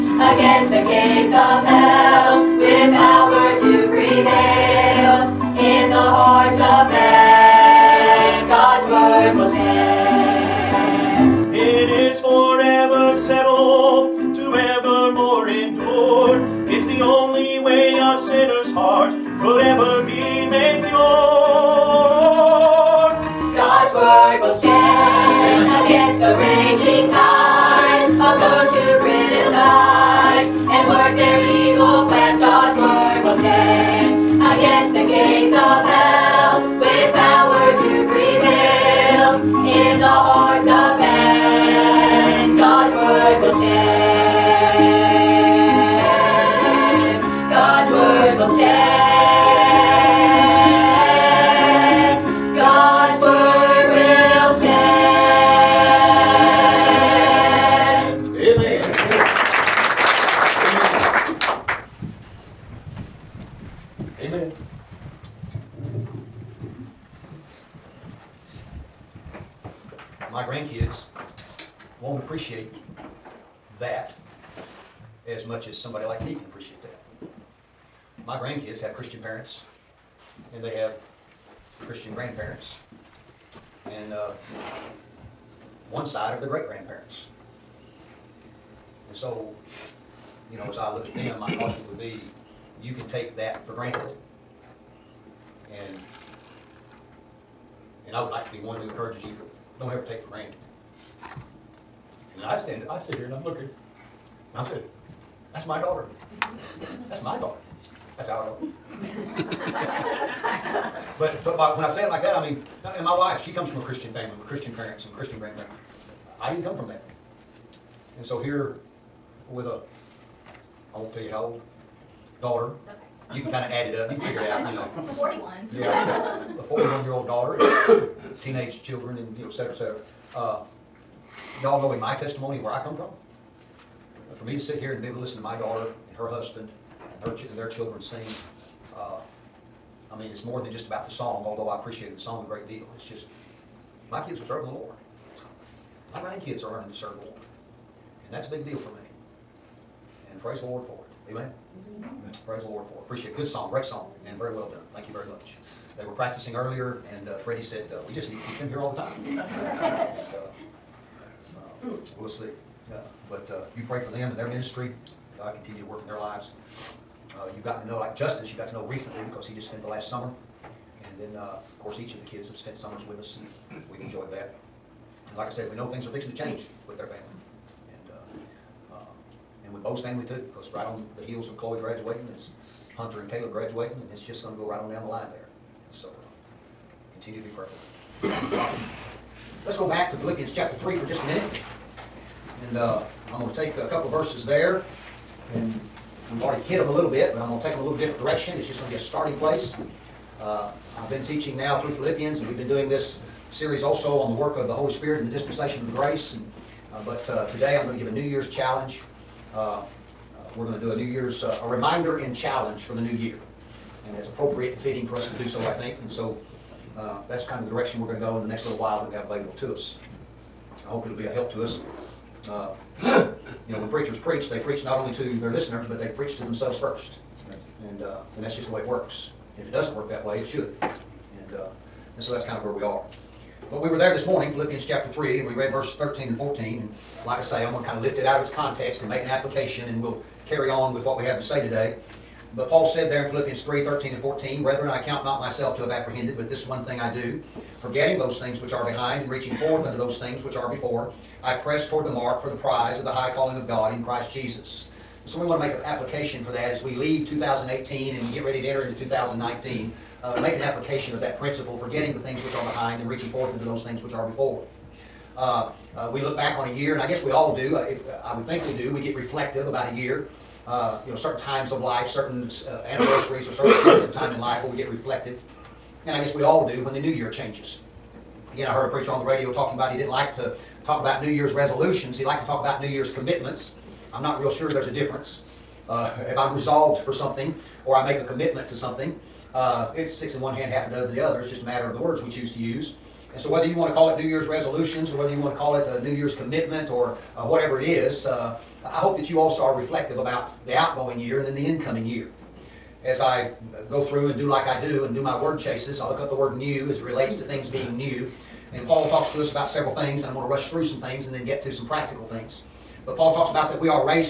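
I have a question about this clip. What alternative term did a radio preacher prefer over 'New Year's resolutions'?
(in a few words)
New Year's commitments.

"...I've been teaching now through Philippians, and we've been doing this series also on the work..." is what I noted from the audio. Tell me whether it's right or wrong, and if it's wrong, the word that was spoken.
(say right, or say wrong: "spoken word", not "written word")
right.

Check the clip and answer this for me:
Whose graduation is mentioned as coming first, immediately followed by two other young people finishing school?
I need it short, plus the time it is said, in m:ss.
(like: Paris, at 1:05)
Chloe, at 3:01.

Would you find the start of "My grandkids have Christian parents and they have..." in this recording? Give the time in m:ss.
1:18.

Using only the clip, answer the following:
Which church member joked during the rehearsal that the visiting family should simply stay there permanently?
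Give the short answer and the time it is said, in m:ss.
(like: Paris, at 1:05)
Freddie, at 2:37.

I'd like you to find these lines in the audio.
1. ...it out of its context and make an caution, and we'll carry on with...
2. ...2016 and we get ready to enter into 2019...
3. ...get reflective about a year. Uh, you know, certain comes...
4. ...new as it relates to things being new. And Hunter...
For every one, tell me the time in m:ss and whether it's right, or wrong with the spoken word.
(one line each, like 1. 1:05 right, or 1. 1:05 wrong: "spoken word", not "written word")
1. 3:58 wrong: "application", not "caution"
2. 4:17 wrong: "2018", not "2016"
3. 4:29 wrong: "times", not "comes"
4. 5:06 wrong: "Paul", not "Hunter".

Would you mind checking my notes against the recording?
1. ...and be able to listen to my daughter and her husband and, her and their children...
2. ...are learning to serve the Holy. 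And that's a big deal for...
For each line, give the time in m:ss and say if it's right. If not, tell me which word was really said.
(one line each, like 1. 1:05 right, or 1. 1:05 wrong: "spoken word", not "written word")
1. 2:14 right
2. 2:26 wrong: "Lord", not "Holy".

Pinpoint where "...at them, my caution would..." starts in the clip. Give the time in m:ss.
1:31.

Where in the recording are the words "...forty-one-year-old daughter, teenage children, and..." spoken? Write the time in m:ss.
2:06.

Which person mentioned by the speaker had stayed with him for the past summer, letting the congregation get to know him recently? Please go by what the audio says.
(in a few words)
Justice.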